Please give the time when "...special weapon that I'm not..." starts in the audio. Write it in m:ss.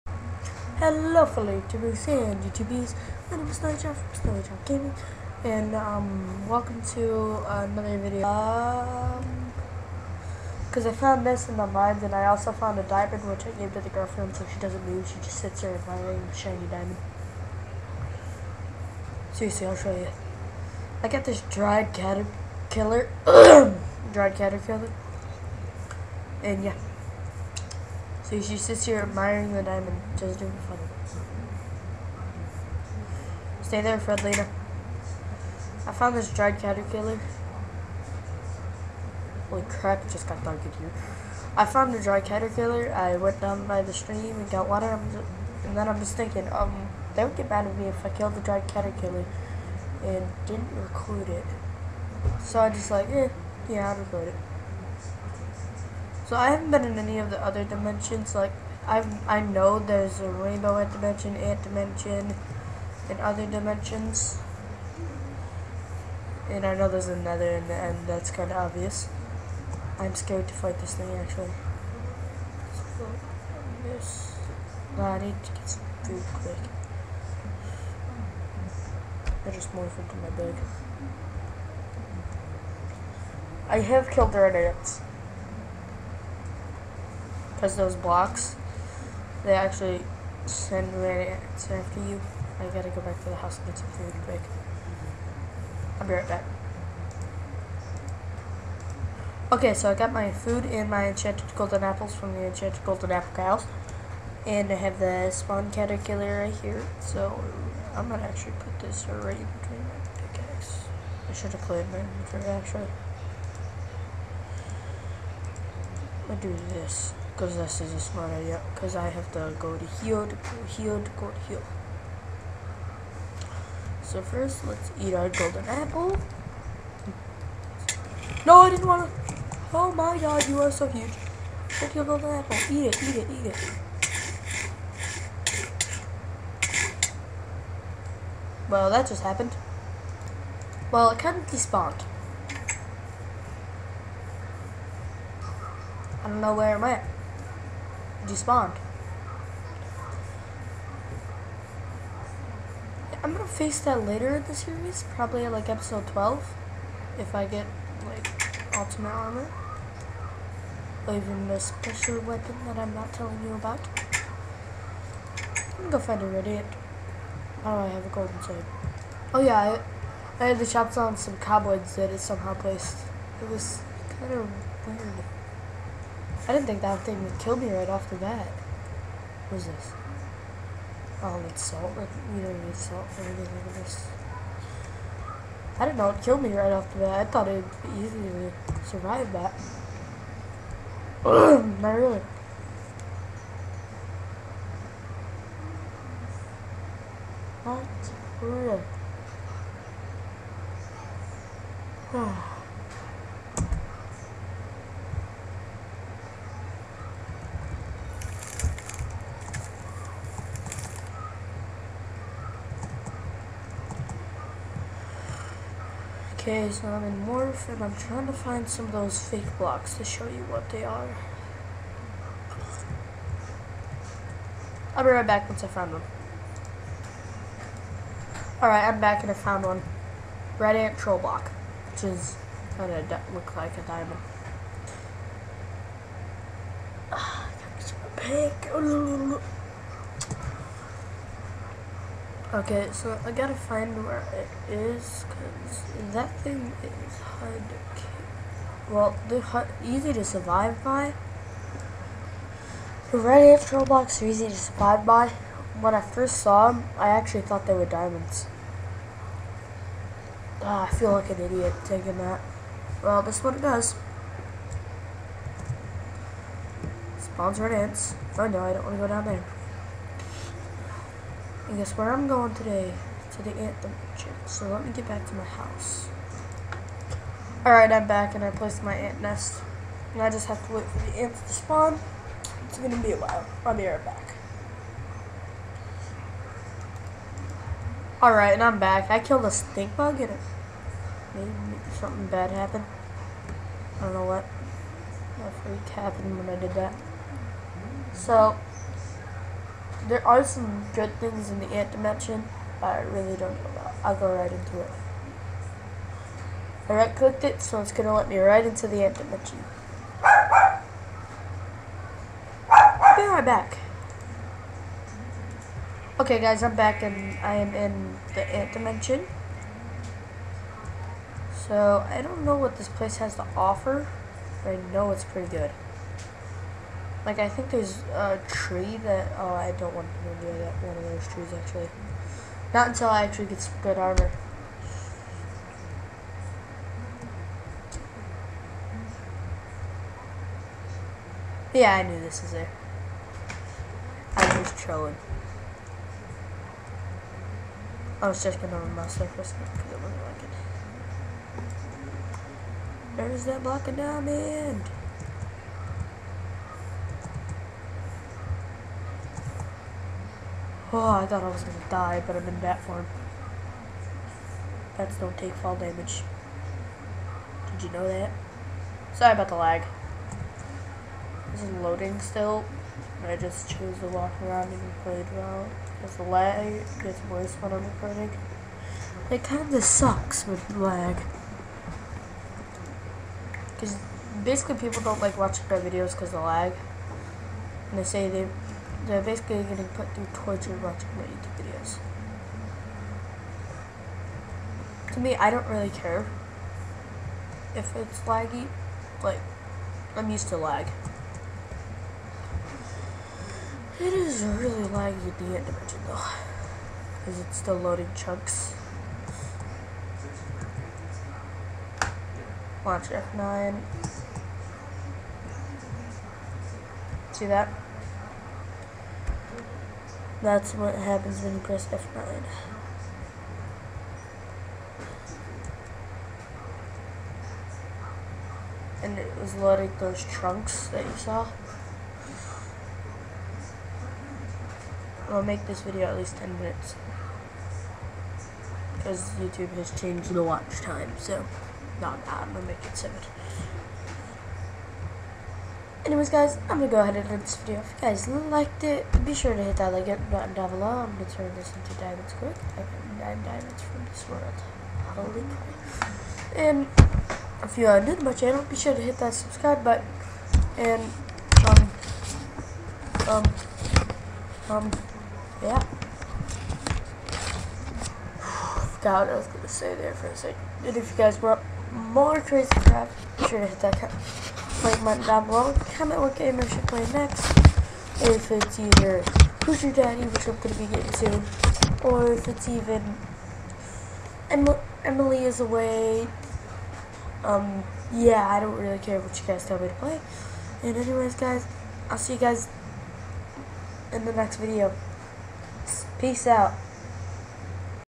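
2:41.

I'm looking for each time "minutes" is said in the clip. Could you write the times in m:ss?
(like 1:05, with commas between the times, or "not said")
7:16.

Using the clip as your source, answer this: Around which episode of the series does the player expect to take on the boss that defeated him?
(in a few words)
Episode 12.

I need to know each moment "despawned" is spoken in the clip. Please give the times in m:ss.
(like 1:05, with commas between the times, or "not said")
2:21, 2:28.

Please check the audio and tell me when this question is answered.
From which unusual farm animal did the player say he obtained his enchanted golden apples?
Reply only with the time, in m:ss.
1:42.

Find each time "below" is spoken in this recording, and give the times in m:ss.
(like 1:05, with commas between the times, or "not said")
7:30, 7:55.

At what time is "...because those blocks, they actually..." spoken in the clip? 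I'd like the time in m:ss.
1:27.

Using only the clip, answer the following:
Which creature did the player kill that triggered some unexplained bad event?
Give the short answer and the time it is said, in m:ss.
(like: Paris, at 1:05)
Stink bug, at 4:49.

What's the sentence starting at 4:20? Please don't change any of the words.
Ah, I feel like an idiot taking that.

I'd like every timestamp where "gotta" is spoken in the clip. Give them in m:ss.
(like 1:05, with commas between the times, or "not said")
1:32, 4:03.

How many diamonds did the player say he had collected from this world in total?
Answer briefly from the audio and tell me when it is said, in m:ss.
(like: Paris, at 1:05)
9, at 7:33.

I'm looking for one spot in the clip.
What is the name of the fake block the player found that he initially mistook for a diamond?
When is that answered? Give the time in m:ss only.
3:50.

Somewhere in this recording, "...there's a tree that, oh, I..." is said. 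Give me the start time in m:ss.
5:27.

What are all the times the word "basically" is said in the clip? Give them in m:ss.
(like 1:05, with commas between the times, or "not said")
6:24, 6:29.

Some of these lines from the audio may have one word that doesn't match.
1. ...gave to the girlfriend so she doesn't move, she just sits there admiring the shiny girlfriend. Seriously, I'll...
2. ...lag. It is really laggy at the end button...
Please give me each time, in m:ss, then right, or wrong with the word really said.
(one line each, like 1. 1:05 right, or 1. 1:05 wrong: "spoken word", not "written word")
1. 0:13 wrong: "diamond", not "girlfriend"
2. 6:40 wrong: "dimension", not "button".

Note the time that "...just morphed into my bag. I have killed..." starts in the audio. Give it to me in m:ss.
1:19.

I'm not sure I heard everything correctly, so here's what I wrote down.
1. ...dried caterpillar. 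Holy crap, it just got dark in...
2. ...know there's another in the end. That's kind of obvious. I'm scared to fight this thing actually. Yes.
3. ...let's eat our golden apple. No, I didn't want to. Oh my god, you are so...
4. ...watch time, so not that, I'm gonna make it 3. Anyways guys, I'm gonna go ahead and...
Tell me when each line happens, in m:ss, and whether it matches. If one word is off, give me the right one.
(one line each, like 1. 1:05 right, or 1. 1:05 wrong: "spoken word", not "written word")
1. 0:36 right
2. 1:06 right
3. 2:04 right
4. 7:20 wrong: "7", not "3".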